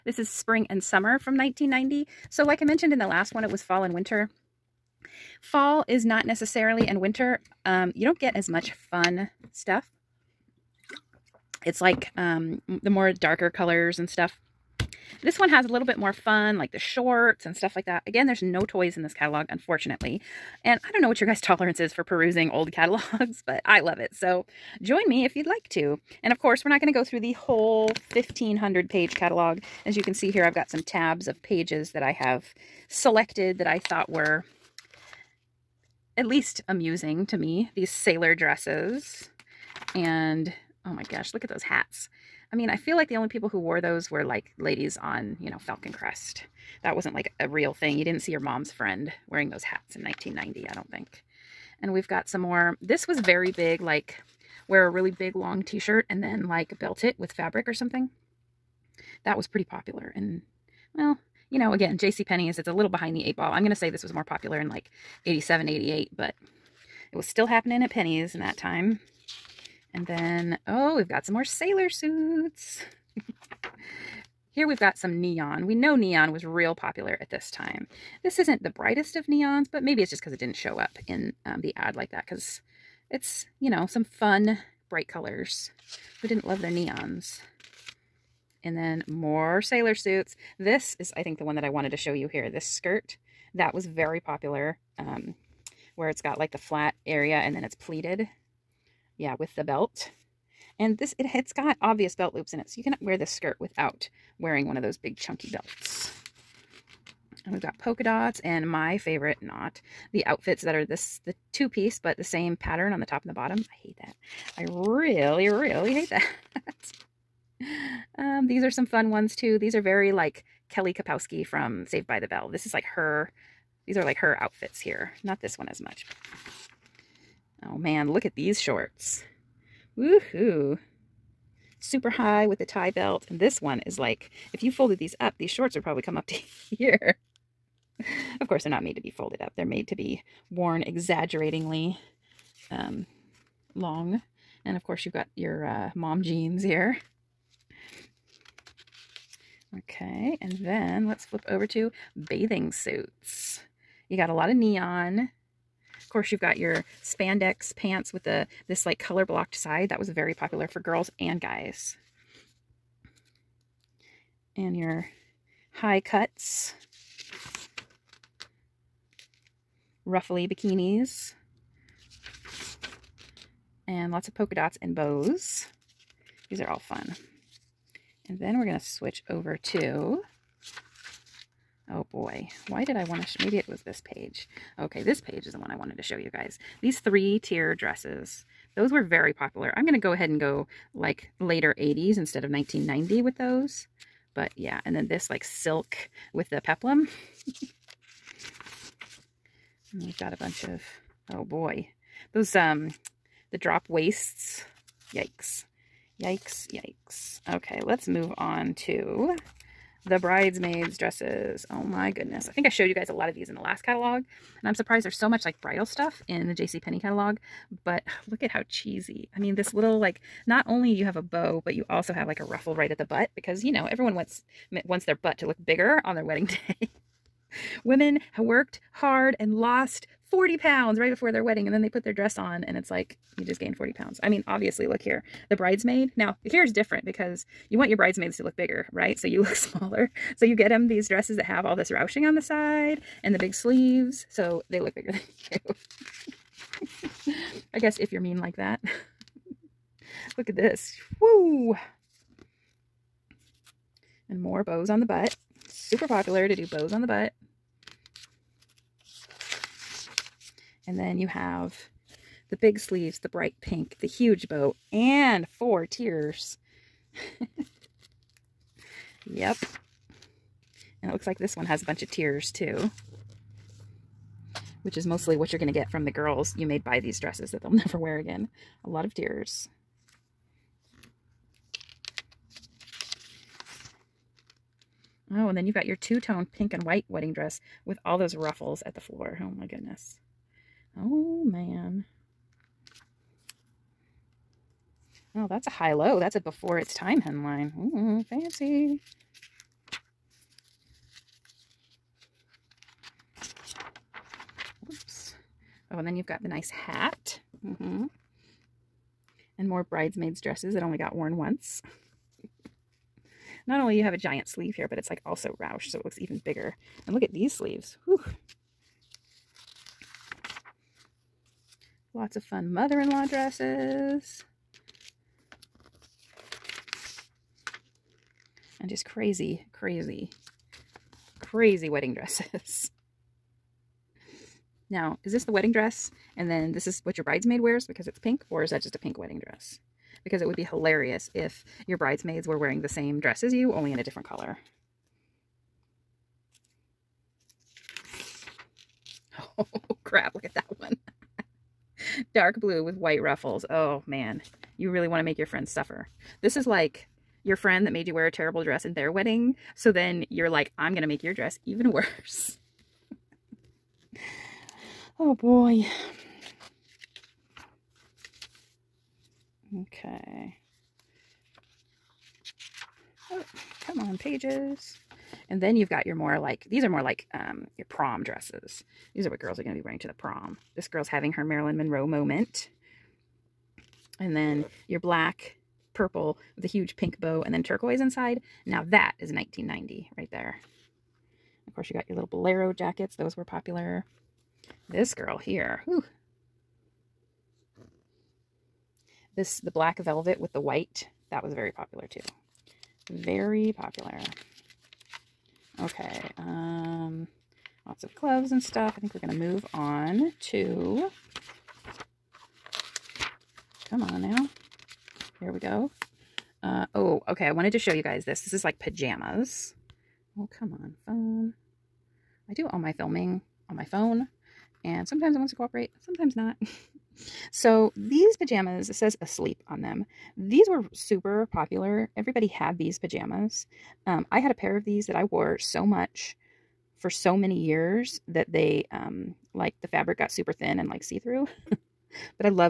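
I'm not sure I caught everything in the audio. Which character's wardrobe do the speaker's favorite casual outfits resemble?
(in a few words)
Kelly Kapowski.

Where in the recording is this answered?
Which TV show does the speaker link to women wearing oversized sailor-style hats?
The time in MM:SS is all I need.
00:45.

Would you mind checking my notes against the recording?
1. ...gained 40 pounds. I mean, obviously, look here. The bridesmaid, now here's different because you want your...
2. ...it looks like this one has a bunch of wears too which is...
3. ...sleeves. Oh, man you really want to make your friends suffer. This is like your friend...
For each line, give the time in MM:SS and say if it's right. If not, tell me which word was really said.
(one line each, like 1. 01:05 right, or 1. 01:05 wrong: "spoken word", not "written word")
1. 03:53 right
2. 04:31 wrong: "tiers", not "wears"
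3. 05:53 wrong: "ruffles", not "sleeves".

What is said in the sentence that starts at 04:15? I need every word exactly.
Super popular to do bows on the butt.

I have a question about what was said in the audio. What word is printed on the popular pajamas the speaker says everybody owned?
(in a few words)
asleep.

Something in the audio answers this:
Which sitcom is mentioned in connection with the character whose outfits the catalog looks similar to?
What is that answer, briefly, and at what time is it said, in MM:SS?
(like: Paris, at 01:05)
Saved by the Bell, at 02:01.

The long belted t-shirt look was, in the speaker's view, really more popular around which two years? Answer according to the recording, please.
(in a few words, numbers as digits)
87, 88.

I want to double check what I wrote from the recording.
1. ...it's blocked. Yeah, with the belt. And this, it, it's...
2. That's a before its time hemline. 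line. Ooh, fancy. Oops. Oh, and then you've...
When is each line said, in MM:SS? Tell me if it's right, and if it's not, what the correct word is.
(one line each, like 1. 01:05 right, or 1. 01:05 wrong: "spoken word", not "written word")
1. 01:37 wrong: "pleated", not "blocked"
2. 04:56 right.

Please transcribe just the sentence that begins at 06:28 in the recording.
Now that is 1990 right there.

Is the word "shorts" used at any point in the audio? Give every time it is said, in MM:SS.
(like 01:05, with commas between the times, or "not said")
00:16, 02:08, 02:15.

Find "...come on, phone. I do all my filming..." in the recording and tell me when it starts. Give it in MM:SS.
07:00.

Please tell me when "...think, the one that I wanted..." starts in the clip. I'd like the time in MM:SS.
01:31.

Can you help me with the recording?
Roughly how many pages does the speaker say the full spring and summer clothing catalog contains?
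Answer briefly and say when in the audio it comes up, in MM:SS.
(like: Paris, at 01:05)
1,500, at 00:28.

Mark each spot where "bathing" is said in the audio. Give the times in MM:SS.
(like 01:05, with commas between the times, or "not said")
02:32.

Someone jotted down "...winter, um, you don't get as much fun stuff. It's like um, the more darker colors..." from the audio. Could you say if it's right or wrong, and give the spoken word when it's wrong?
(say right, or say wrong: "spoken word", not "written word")
right.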